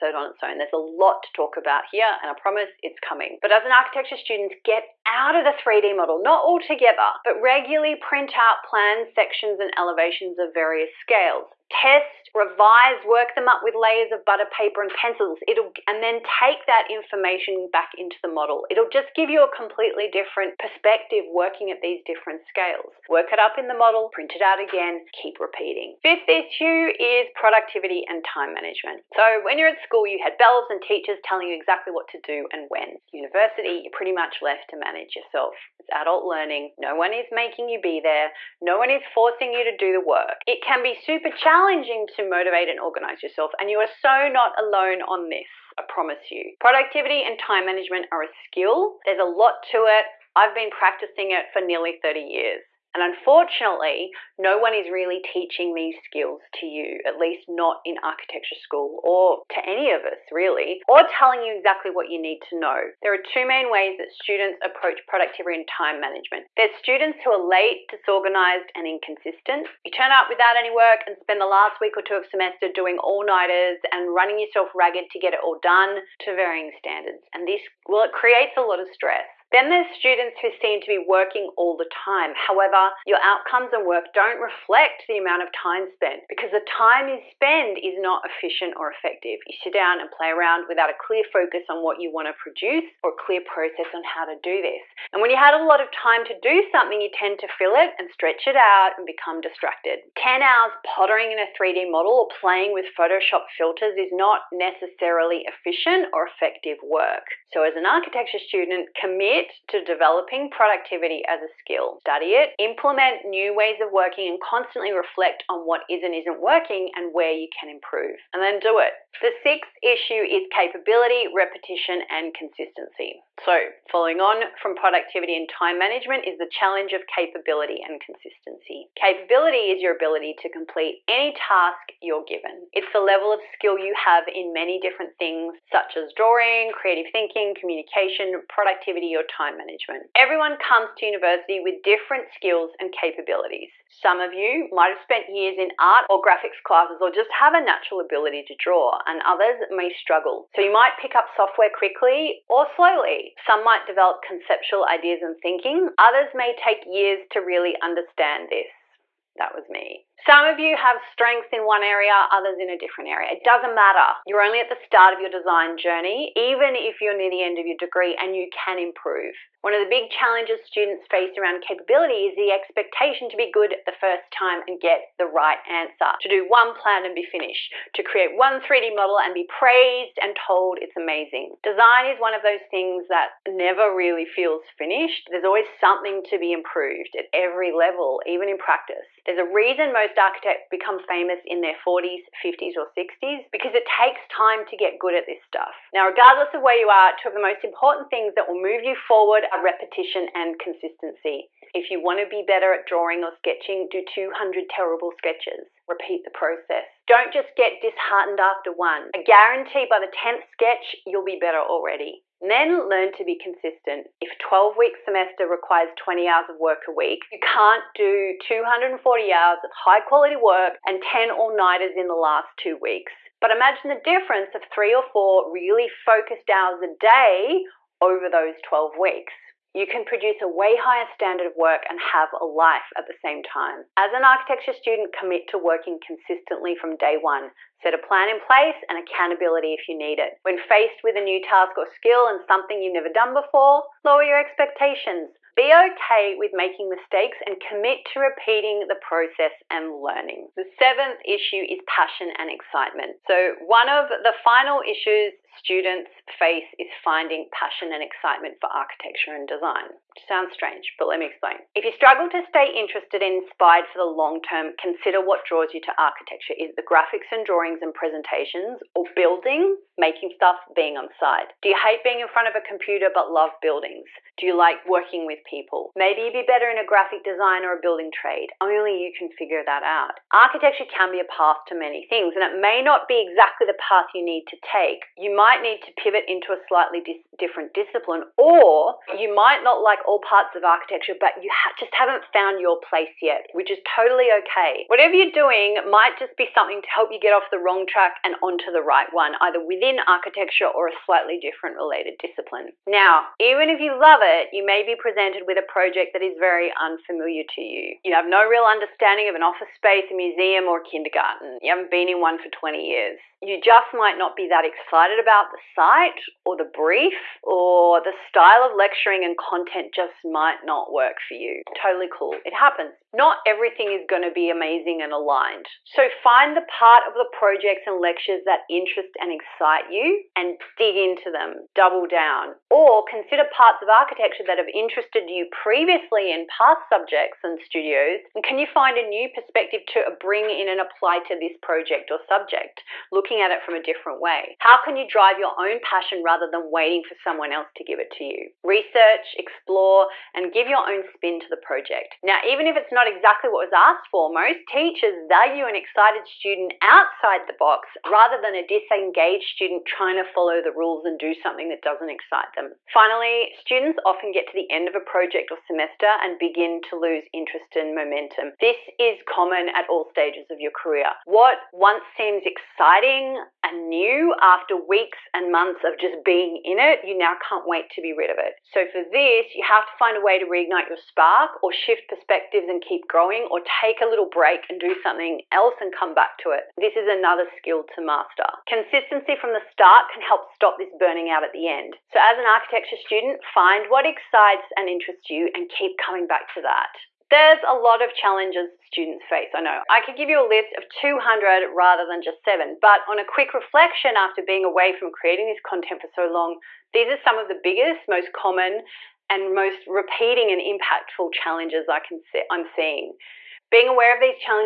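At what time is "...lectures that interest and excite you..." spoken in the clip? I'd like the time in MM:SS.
05:28.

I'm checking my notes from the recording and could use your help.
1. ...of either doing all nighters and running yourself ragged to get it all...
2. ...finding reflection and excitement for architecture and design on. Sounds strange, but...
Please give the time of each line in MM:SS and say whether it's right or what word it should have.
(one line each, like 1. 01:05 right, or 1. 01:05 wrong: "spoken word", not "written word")
1. 01:12 wrong: "semester", not "either"
2. 04:16 wrong: "passion", not "reflection".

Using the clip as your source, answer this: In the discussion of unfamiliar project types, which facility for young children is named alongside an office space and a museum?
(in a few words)
kindergarten.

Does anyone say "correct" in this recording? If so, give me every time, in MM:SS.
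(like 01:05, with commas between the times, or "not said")
not said.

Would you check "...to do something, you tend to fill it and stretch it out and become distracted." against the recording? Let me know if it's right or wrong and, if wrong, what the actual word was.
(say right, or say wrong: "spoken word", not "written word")
right.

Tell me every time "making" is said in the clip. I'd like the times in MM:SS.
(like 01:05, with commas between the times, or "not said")
00:37, 04:06, 04:29.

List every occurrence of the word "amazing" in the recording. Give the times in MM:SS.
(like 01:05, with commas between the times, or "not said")
03:00, 05:24.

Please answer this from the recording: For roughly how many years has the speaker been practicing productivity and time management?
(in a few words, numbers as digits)
30.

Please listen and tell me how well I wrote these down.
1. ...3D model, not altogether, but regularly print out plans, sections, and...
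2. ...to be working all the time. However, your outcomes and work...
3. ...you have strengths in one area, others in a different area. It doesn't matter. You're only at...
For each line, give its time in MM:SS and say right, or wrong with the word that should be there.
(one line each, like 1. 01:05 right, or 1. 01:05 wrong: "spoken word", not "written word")
1. 00:05 right
2. 01:20 right
3. 02:40 right.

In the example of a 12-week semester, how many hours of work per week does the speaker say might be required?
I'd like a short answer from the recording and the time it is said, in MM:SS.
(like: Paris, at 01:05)
20, at 03:35.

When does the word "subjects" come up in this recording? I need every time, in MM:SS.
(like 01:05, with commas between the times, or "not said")
05:36, 05:42.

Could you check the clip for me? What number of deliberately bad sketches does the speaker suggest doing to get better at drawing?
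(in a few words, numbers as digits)
200.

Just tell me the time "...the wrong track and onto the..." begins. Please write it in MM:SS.
04:57.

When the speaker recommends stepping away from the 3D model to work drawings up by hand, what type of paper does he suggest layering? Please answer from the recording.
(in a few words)
butter paper.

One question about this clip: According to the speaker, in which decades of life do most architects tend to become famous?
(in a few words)
40s, 50s, or 60s.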